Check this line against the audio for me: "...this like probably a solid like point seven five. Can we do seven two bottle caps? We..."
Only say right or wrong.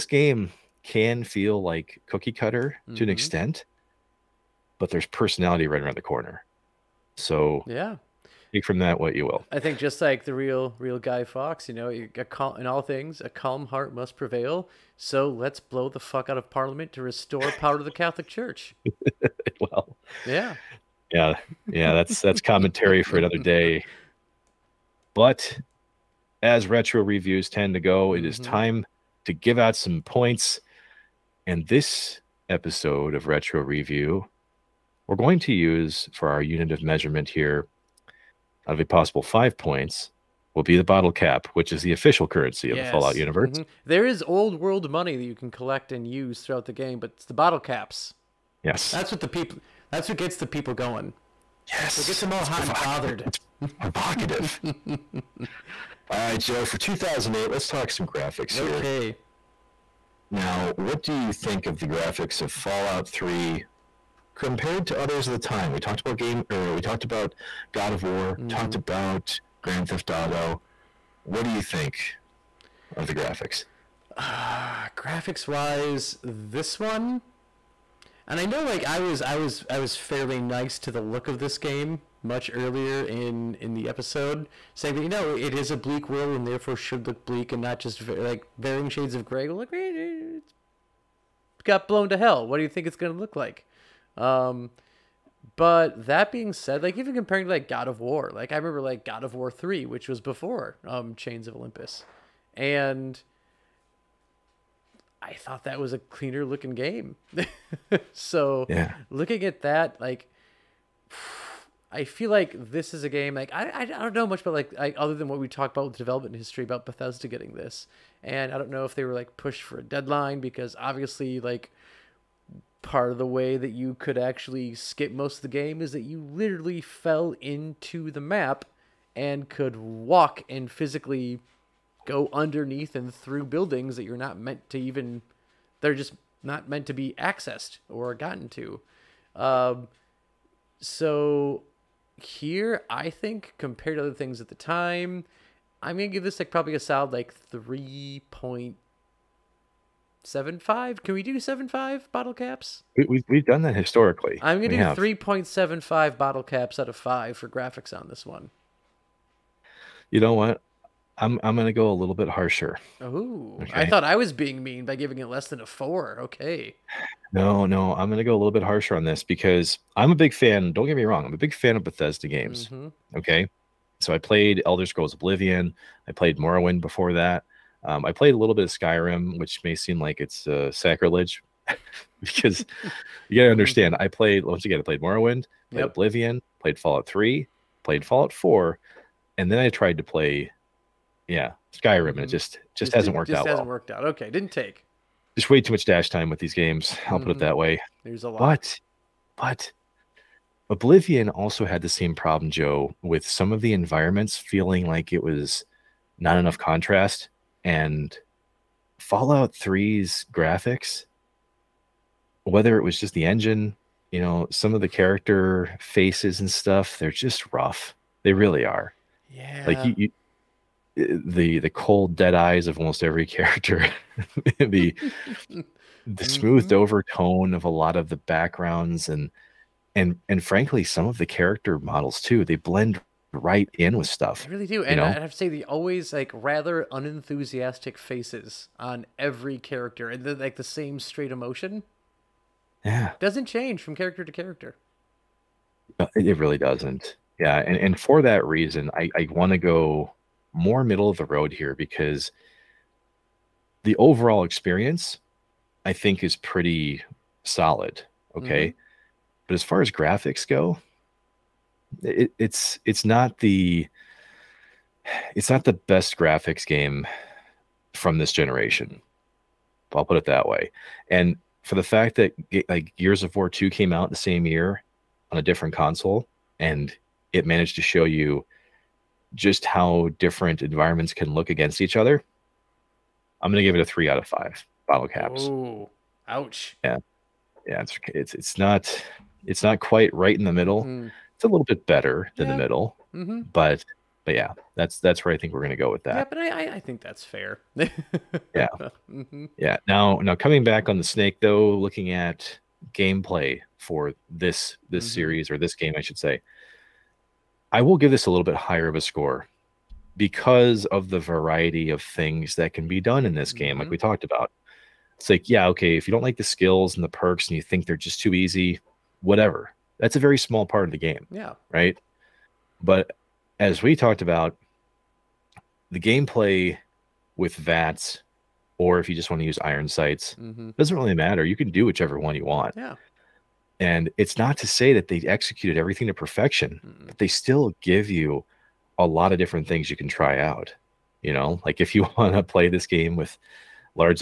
wrong.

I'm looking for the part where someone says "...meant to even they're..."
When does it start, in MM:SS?
02:14.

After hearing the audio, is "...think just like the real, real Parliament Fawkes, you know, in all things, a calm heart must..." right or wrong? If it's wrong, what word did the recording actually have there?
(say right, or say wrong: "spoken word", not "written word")
wrong: "Guy", not "Parliament".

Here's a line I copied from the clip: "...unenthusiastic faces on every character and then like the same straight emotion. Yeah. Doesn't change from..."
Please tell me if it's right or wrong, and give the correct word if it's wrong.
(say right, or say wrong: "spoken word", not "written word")
right.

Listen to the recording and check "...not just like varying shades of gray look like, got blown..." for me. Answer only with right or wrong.
right.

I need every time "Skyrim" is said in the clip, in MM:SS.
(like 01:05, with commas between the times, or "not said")
02:58, 03:11.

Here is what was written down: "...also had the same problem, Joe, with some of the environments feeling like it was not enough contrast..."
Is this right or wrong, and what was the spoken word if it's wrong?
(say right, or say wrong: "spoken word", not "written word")
right.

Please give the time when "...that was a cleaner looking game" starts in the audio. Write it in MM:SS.
01:45.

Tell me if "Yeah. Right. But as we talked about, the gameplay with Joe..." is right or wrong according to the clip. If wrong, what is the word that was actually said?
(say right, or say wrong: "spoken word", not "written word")
wrong: "VATS", not "Joe".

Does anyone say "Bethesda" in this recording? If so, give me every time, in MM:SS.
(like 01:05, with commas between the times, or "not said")
01:56, 02:51.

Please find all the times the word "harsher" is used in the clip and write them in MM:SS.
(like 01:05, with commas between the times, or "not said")
02:42, 02:48.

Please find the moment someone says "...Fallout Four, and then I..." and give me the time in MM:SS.
03:08.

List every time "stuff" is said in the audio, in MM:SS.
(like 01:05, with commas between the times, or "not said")
03:36, 03:54.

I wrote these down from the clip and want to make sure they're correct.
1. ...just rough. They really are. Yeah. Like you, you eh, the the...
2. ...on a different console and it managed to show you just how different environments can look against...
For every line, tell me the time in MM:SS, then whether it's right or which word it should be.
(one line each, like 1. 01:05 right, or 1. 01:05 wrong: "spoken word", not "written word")
1. 03:37 right
2. 04:35 right.